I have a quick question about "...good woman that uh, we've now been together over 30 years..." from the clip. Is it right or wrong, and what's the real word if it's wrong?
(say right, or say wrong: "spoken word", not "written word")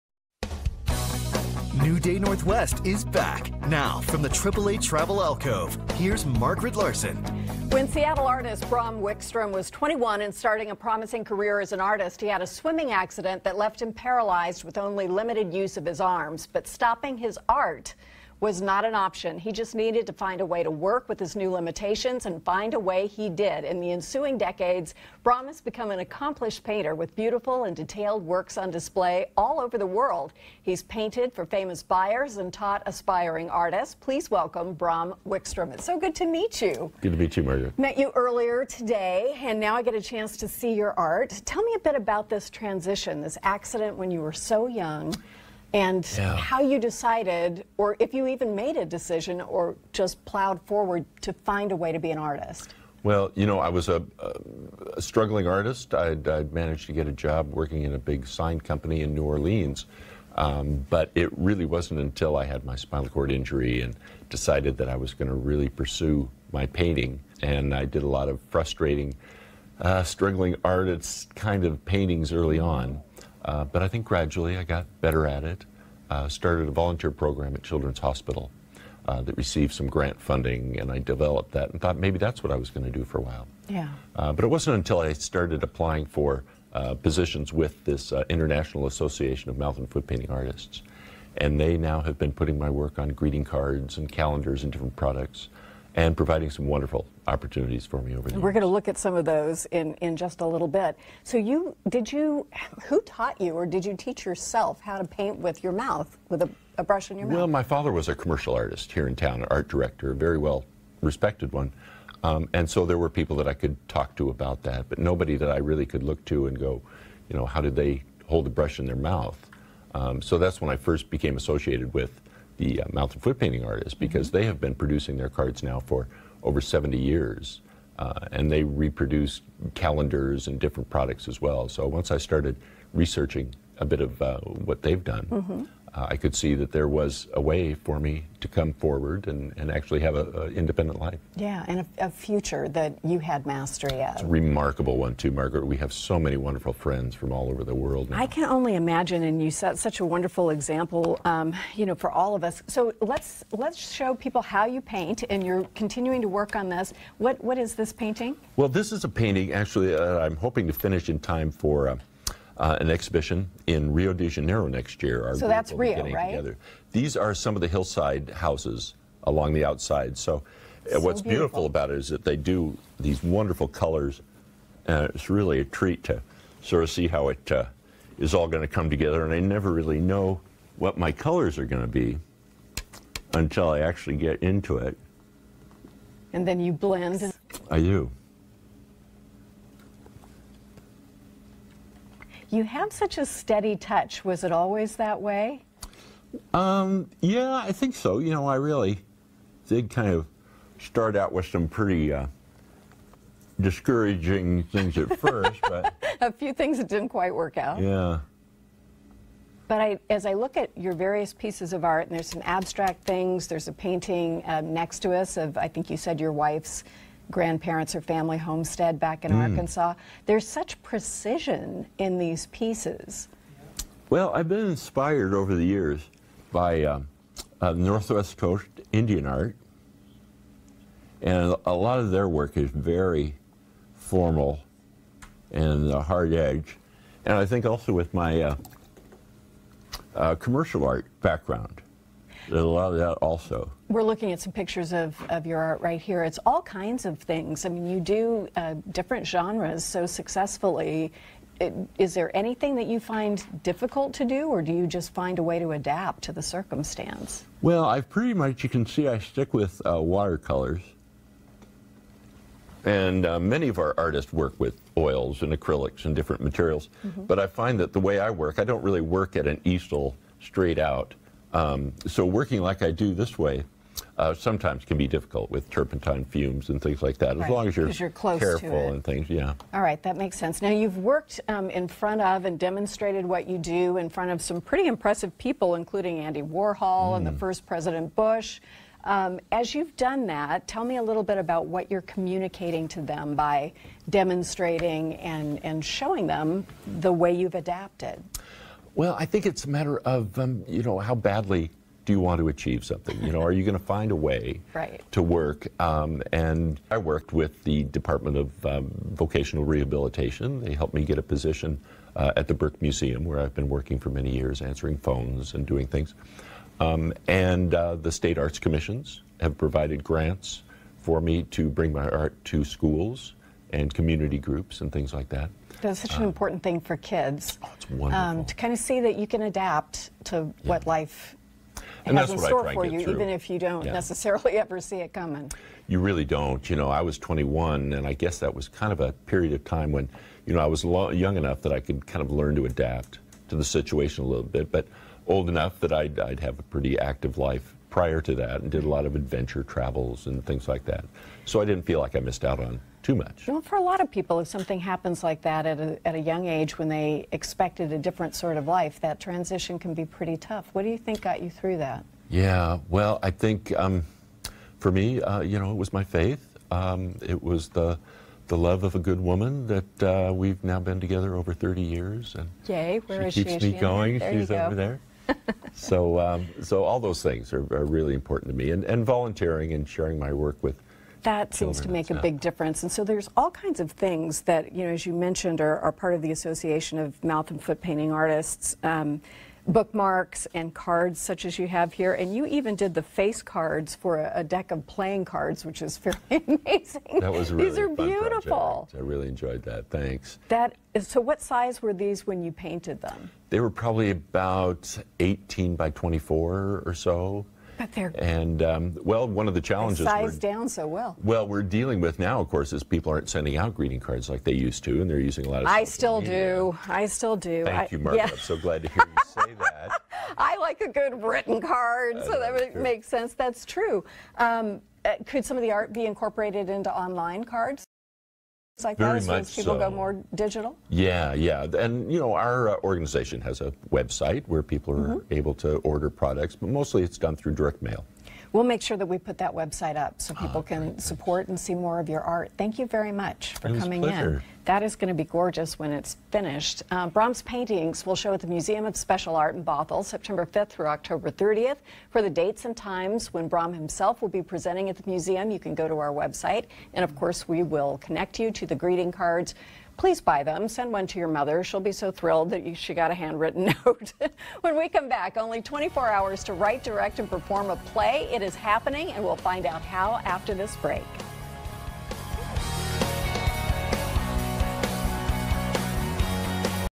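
right.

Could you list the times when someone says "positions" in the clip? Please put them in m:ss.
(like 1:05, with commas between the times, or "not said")
1:26, 5:11.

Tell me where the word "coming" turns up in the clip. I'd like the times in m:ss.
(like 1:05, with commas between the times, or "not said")
5:35, 7:23.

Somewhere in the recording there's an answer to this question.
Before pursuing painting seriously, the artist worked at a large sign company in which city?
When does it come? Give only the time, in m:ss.
0:59.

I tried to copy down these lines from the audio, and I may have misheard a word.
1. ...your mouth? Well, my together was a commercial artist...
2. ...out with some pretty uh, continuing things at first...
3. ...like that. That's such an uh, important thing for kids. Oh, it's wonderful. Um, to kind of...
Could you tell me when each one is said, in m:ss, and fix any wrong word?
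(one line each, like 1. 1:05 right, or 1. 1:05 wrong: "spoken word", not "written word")
1. 1:47 wrong: "father", not "together"
2. 3:21 wrong: "discouraging", not "continuing"
3. 5:25 right.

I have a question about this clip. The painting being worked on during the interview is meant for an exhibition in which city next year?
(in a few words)
Rio de Janeiro.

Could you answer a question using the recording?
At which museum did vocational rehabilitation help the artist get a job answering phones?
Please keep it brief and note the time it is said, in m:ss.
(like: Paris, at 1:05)
Burke Museum, at 5:12.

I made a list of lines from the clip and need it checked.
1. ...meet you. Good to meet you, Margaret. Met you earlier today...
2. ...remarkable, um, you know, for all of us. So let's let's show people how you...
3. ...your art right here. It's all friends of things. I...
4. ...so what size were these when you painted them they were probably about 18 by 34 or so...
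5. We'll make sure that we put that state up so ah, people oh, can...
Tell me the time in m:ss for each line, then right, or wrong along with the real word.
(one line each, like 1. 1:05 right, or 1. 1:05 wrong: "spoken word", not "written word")
1. 0:36 right
2. 2:30 wrong: "example", not "remarkable"
3. 4:05 wrong: "kinds", not "friends"
4. 6:41 wrong: "24", not "34"
5. 7:18 wrong: "website", not "state".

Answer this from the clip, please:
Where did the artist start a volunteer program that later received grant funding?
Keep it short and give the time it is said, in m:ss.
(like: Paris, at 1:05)
Children's Hospital, at 1:17.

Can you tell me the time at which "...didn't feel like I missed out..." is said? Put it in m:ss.
5:51.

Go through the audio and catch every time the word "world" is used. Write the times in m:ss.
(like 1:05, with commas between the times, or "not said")
0:29, 2:27.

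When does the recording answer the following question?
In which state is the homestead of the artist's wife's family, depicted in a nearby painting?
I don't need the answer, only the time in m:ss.
3:39.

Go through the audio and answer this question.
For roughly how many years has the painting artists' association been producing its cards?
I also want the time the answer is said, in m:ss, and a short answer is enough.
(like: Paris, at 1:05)
over 70 years, at 2:06.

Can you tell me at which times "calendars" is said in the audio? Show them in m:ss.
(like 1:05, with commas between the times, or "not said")
1:34, 2:09.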